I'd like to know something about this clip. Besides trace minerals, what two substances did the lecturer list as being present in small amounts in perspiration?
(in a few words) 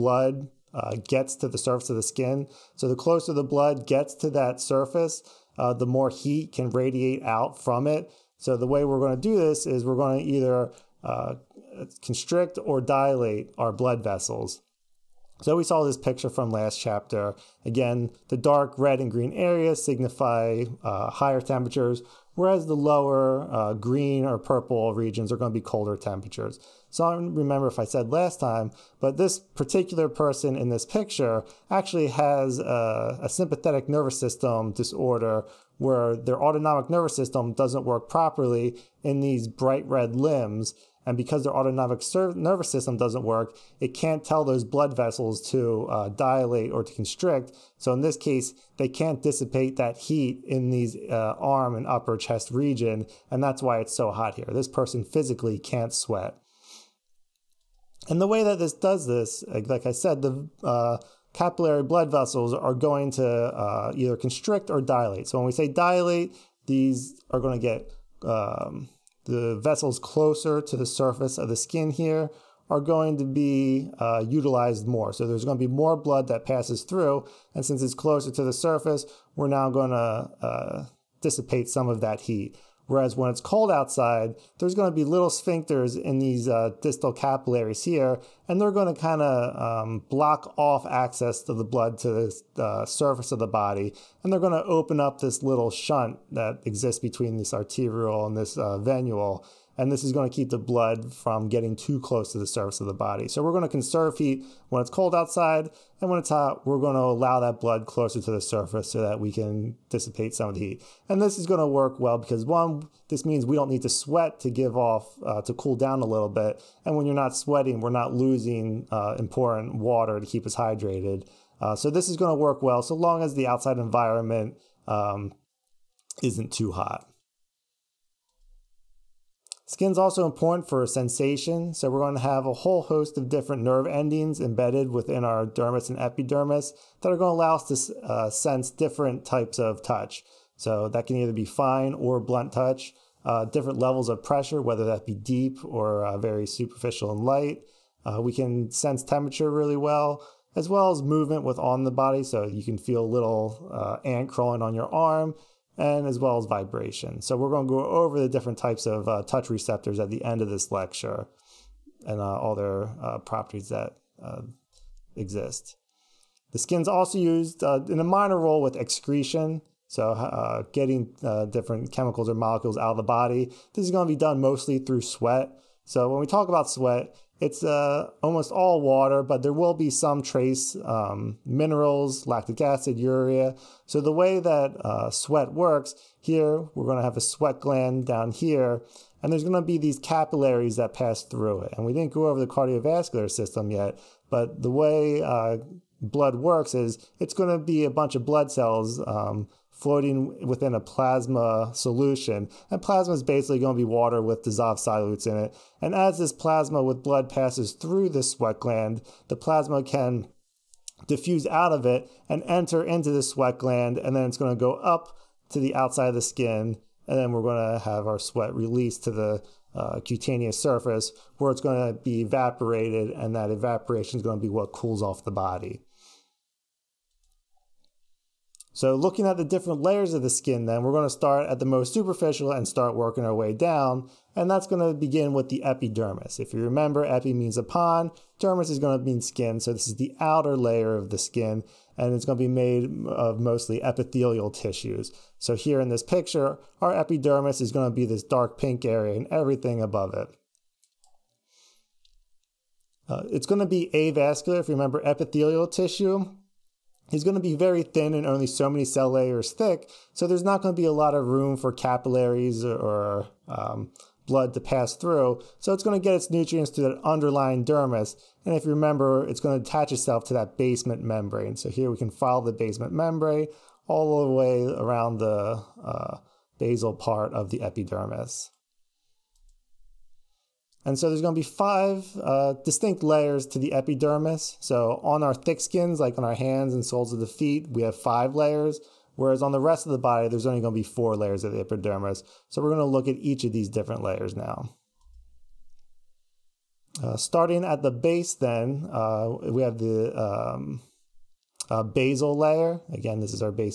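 lactic acid, urea.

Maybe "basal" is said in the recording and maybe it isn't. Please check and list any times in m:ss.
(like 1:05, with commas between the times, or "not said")
4:36, 5:01.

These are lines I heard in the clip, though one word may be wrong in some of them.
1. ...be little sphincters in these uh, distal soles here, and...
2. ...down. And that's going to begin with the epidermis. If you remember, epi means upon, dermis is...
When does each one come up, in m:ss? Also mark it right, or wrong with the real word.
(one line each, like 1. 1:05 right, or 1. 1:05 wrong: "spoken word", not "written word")
1. 1:24 wrong: "capillaries", not "soles"
2. 3:53 right.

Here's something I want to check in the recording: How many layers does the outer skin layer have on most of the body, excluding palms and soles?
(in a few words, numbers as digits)
4.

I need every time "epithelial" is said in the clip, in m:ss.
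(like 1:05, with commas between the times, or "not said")
4:03, 4:15.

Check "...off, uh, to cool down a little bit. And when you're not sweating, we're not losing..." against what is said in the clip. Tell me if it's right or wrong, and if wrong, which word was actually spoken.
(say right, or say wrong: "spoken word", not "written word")
right.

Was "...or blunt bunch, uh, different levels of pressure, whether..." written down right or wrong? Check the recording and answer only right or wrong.
wrong.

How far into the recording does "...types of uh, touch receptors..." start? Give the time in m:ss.
2:38.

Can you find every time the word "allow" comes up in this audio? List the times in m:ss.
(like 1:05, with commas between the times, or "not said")
1:47, 2:17.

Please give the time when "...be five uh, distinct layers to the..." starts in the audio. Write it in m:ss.
4:41.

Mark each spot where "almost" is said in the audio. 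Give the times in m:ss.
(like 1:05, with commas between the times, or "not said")
2:58.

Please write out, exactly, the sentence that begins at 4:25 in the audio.
So it's going to get its nutrients to that underlying dermis.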